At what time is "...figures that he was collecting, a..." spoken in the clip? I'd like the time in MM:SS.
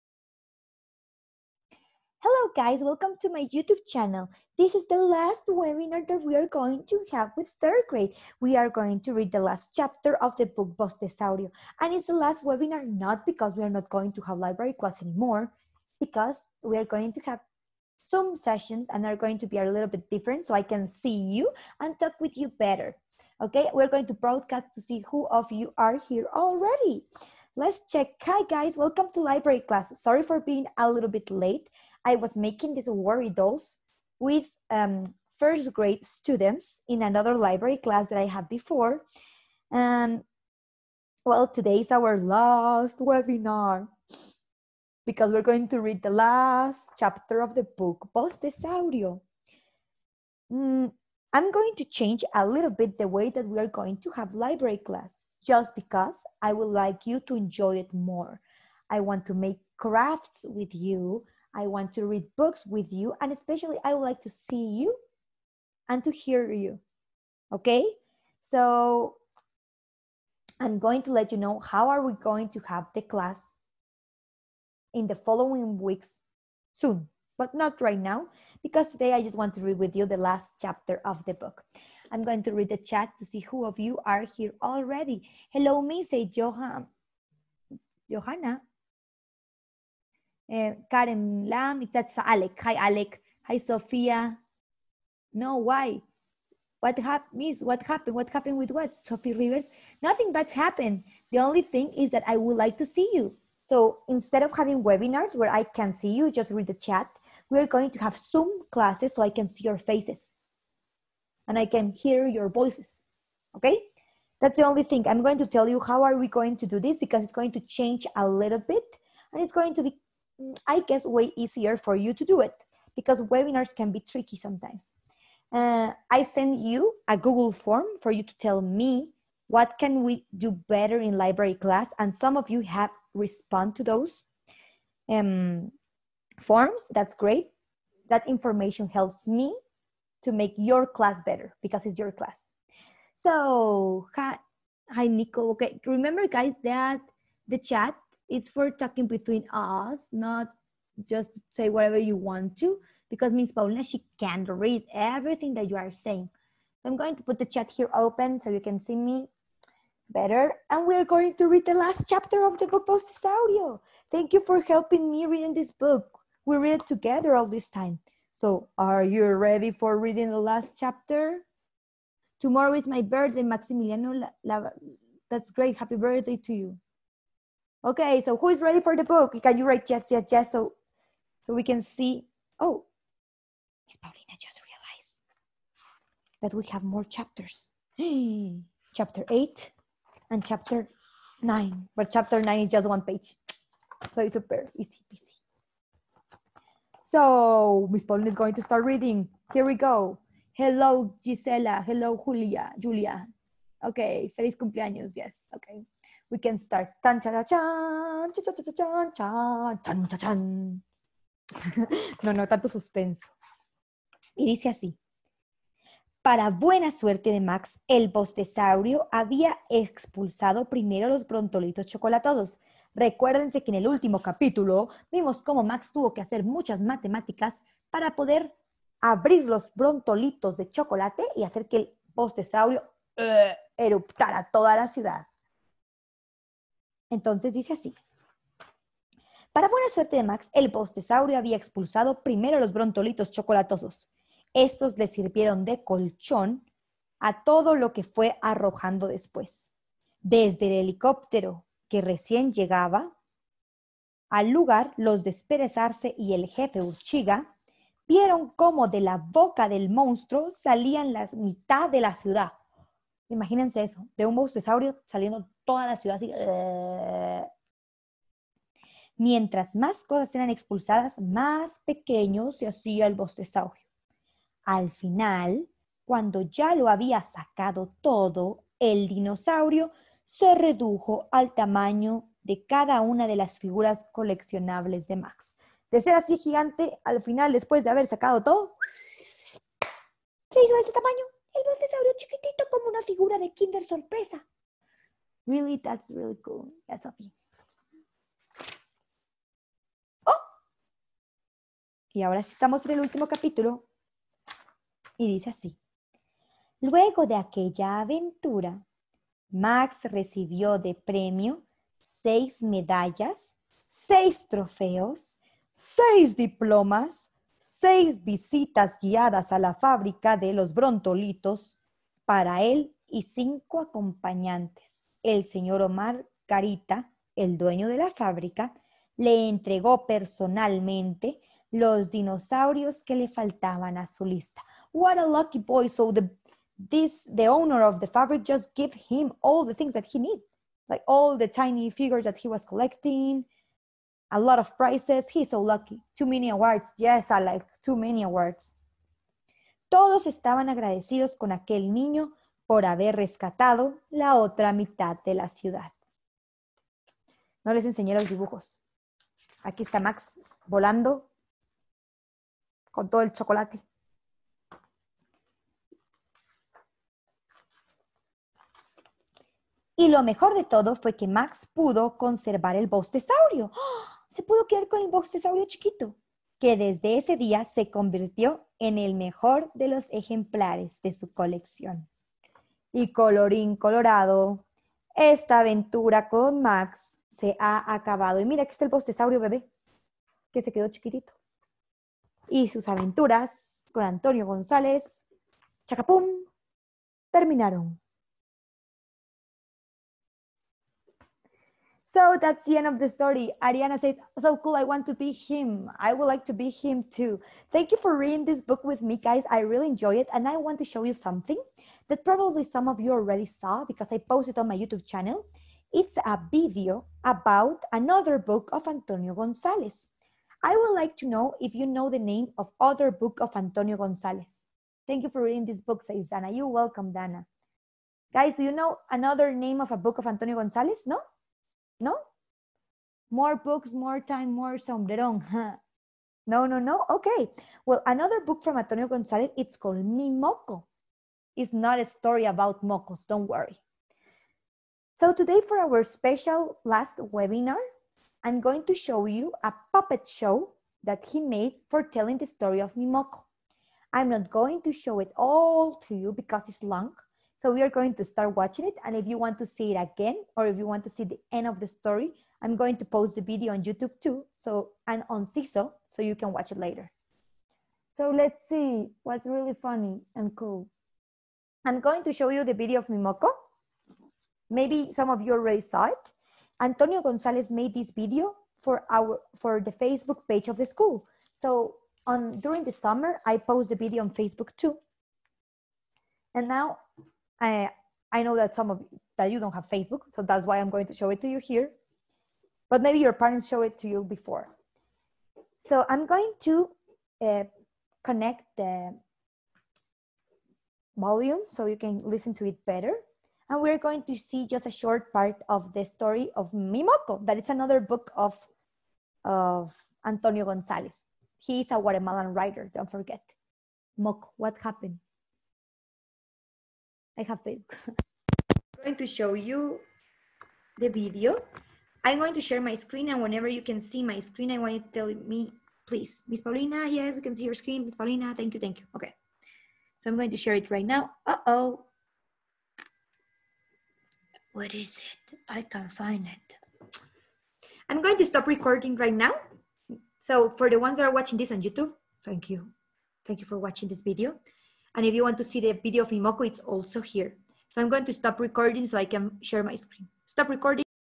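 05:41.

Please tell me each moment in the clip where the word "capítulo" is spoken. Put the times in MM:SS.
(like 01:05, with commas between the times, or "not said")
03:44, 05:03.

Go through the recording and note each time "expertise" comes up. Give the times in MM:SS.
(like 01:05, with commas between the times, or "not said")
not said.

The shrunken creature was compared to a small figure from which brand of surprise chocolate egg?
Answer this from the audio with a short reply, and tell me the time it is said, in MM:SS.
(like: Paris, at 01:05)
Kinder sorpresa, at 04:53.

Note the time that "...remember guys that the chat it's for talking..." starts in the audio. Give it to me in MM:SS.
02:25.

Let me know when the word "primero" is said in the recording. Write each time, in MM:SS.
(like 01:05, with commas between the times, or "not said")
03:40, 04:02.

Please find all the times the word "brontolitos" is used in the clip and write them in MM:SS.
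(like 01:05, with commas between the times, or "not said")
03:41, 03:49, 04:02, 05:20.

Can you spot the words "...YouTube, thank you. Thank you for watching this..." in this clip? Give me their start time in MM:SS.
09:01.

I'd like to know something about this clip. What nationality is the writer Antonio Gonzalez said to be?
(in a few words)
Guatemalan.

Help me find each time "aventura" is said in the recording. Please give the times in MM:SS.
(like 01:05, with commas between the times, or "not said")
05:07, 06:25, 06:32.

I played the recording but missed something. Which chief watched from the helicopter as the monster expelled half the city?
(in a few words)
Urchiga.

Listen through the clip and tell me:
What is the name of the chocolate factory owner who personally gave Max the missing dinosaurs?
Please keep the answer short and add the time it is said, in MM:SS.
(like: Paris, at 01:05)
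Omar Carita, at 05:25.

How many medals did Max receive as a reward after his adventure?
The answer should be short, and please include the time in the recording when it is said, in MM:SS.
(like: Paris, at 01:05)
6, at 05:12.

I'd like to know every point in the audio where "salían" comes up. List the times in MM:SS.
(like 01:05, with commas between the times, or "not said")
04:20.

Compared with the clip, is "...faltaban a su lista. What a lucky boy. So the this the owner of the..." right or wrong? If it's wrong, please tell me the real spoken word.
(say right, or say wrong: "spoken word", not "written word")
right.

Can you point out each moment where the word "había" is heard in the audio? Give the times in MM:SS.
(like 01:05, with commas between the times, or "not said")
03:39, 04:01, 04:36.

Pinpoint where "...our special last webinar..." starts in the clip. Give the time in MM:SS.
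07:25.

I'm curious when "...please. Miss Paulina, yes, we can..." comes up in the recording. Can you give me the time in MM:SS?
08:46.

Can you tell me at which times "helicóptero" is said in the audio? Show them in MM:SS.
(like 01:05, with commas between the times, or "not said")
04:10.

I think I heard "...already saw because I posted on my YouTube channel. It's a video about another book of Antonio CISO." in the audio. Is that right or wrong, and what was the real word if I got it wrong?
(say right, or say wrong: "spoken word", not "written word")
wrong: "Gonzalez", not "CISO".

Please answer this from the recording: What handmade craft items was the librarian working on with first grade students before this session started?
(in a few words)
worry dolls.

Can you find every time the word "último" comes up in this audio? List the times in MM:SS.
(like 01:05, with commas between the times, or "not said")
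03:43, 05:03.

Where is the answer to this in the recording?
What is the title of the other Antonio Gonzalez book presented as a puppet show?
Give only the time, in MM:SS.
07:20.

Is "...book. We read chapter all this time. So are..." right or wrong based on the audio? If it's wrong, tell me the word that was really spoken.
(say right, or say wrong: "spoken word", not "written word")
wrong: "together", not "chapter".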